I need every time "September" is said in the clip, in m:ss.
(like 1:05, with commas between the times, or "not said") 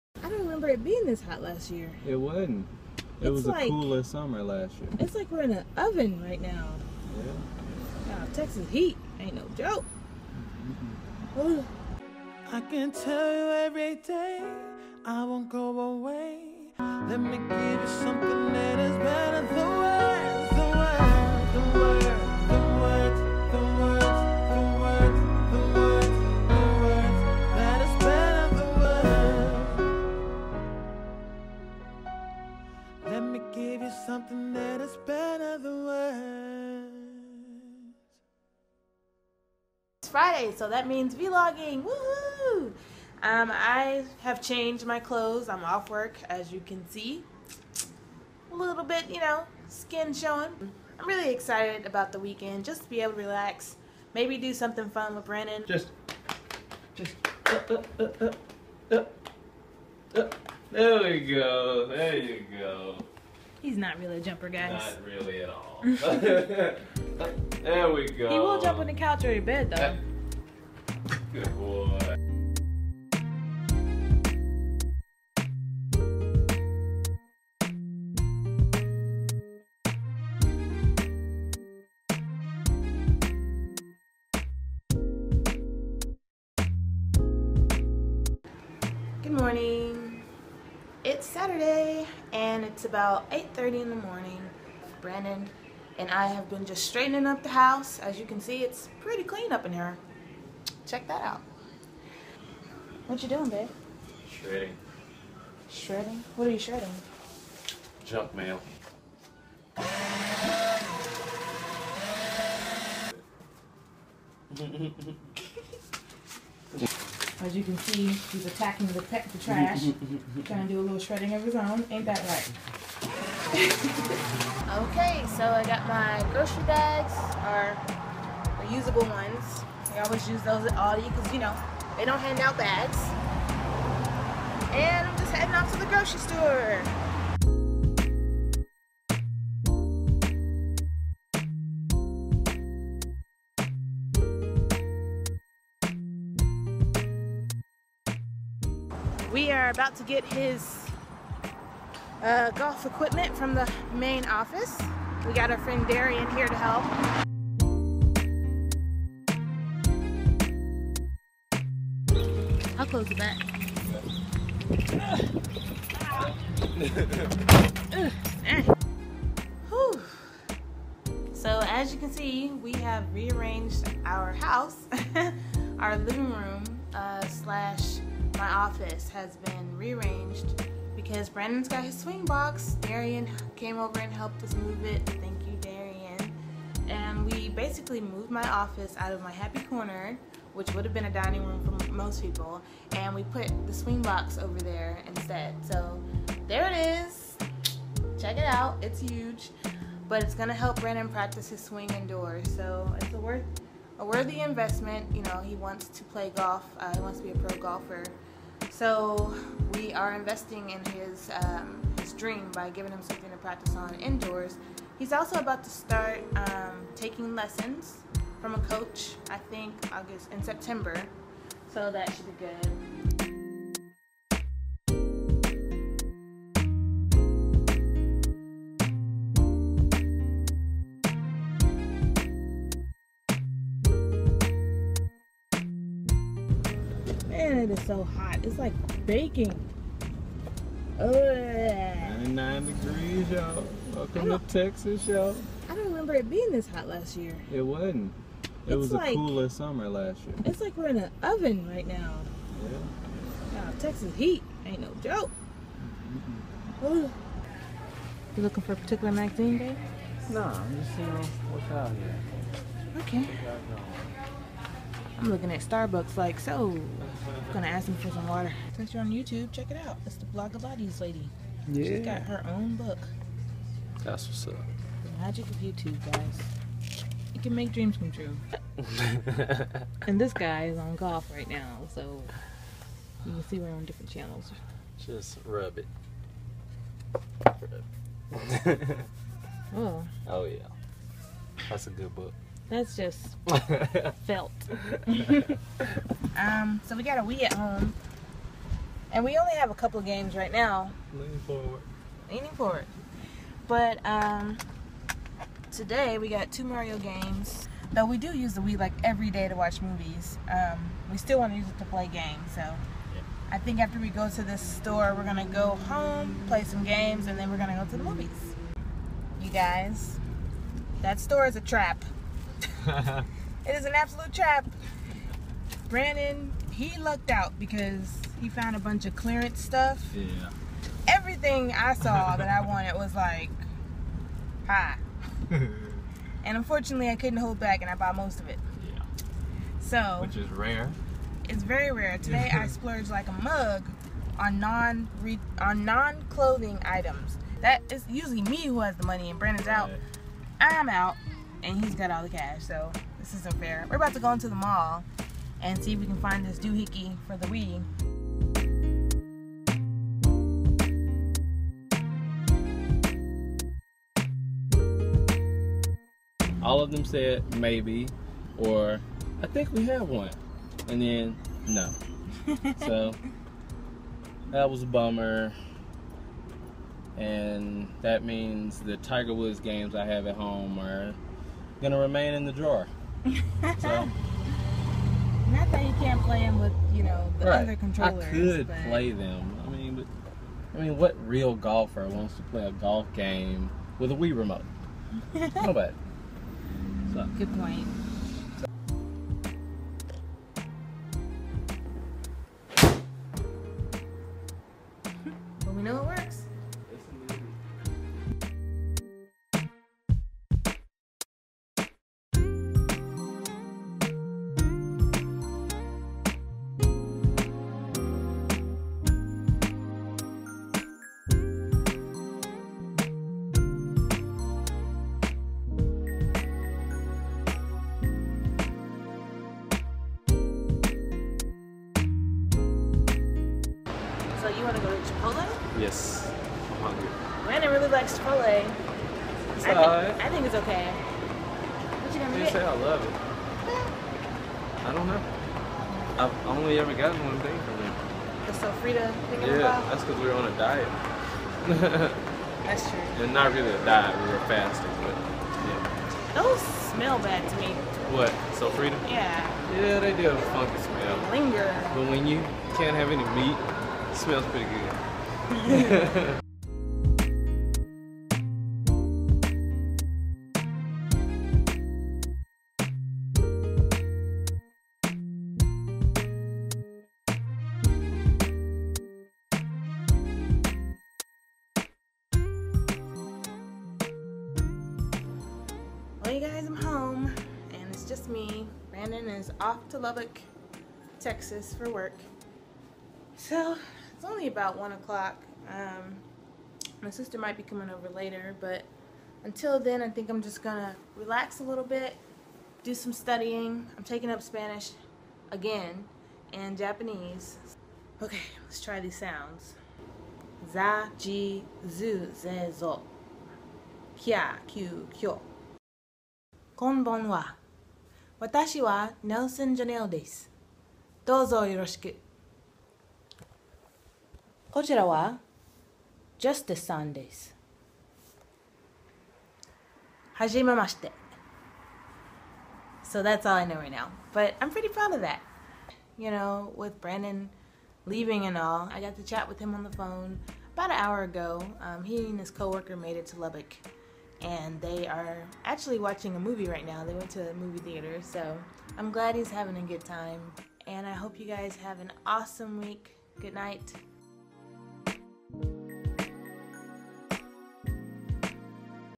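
3:40.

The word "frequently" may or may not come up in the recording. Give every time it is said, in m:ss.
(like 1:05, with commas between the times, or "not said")
not said.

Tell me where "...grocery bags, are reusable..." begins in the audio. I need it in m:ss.
2:06.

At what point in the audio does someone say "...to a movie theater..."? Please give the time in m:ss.
9:07.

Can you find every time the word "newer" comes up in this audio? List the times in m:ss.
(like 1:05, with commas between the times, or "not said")
not said.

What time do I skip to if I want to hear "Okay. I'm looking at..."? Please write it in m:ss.
4:23.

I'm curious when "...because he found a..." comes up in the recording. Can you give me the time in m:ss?
5:27.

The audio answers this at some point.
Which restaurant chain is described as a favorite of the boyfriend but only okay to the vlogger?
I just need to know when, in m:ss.
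7:18.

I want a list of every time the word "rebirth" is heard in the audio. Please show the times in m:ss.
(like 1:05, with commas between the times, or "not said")
not said.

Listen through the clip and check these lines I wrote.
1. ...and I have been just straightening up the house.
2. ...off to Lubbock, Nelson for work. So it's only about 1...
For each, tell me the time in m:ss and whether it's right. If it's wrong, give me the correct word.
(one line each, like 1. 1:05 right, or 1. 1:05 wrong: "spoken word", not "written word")
1. 1:35 right
2. 8:09 wrong: "Texas", not "Nelson".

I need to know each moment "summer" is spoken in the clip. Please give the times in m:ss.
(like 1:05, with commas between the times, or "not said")
0:04, 4:09.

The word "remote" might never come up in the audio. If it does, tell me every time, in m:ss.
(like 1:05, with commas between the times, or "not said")
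6:34.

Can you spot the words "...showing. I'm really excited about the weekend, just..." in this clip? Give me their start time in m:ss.
0:50.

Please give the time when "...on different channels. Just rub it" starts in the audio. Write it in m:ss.
4:43.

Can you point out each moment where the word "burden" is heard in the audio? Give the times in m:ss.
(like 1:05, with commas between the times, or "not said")
not said.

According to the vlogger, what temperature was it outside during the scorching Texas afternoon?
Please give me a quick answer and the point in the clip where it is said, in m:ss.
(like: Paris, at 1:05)
99 degrees, at 4:01.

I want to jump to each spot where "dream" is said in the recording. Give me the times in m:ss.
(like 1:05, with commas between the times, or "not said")
3:32, 4:37.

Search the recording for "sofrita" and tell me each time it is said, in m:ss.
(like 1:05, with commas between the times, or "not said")
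7:28, 7:38.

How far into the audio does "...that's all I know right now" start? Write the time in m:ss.
8:53.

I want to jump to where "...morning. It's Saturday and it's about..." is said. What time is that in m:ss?
1:29.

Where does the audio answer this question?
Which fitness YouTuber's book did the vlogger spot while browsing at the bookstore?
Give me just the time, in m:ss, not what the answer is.
4:30.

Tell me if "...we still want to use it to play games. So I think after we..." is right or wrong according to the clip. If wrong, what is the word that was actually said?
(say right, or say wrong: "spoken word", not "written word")
right.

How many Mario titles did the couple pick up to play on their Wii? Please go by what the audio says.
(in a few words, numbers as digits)
2.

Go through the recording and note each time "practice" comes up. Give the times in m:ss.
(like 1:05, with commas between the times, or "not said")
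3:21, 3:33.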